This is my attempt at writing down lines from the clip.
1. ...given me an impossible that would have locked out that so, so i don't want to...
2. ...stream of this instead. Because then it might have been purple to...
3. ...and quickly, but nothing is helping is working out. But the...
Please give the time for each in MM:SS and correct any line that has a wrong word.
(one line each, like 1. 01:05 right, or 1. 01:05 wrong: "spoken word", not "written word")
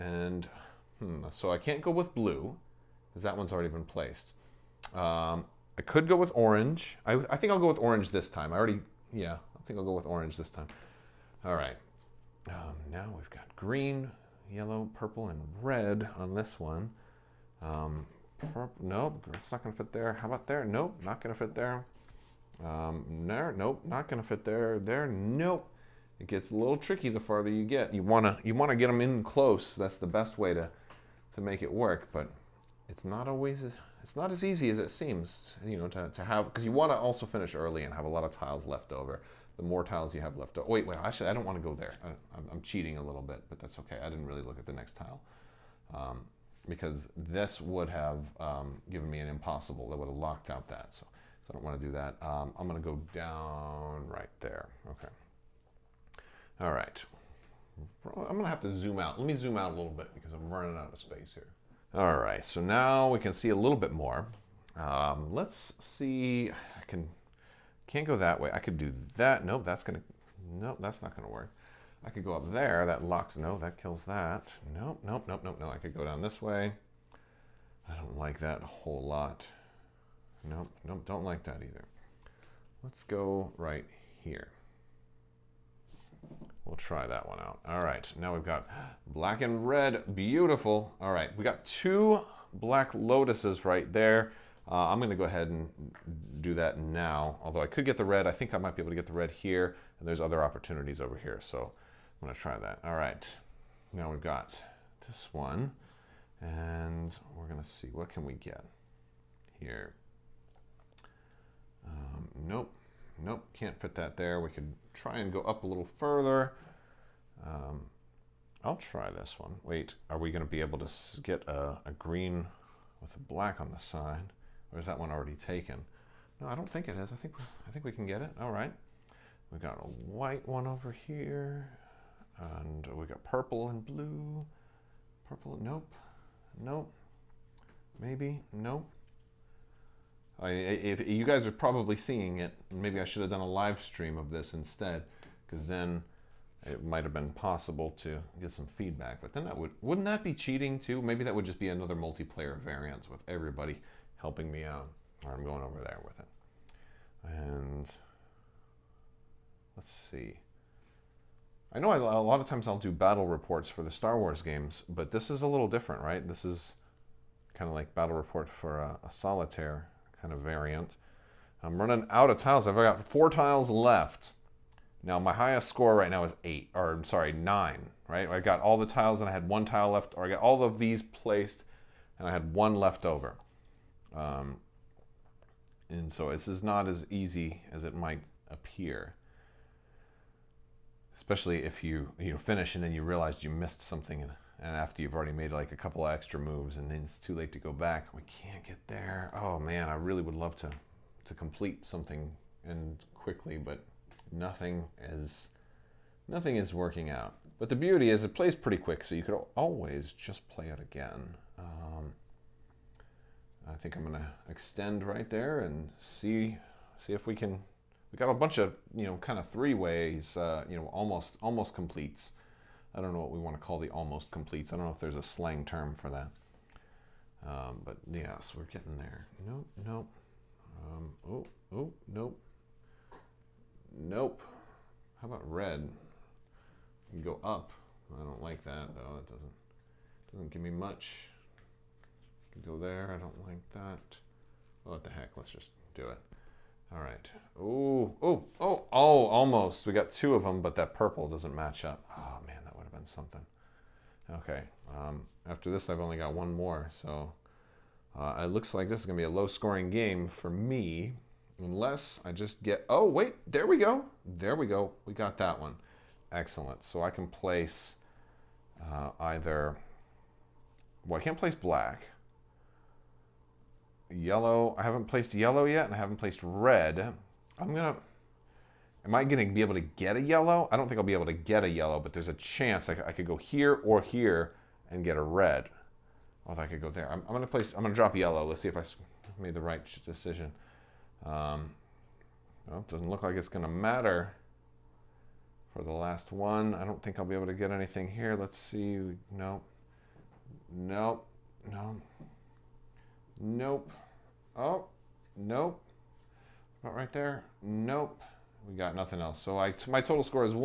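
1. 00:48 right
2. 02:23 wrong: "possible", not "purple"
3. 03:22 wrong: "nothing", not "helping".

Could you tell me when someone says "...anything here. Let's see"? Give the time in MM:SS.
04:57.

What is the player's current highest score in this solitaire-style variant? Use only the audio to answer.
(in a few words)
9.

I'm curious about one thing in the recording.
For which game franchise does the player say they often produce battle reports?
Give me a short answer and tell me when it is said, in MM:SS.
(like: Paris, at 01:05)
Star Wars, at 02:43.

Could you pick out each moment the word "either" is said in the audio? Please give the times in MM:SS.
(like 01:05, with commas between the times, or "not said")
01:21, 04:29.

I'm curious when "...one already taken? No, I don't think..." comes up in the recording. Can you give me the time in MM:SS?
02:04.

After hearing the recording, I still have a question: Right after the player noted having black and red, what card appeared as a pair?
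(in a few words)
black lotuses.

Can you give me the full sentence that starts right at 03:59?
It doesn't doesn't give me much.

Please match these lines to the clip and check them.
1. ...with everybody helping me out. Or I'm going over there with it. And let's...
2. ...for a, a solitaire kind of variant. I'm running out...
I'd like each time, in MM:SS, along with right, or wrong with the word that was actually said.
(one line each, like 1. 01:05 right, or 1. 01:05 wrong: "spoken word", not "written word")
1. 02:33 right
2. 02:48 right.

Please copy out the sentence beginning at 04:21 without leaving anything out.
Unless I just get, oh wait, there we go.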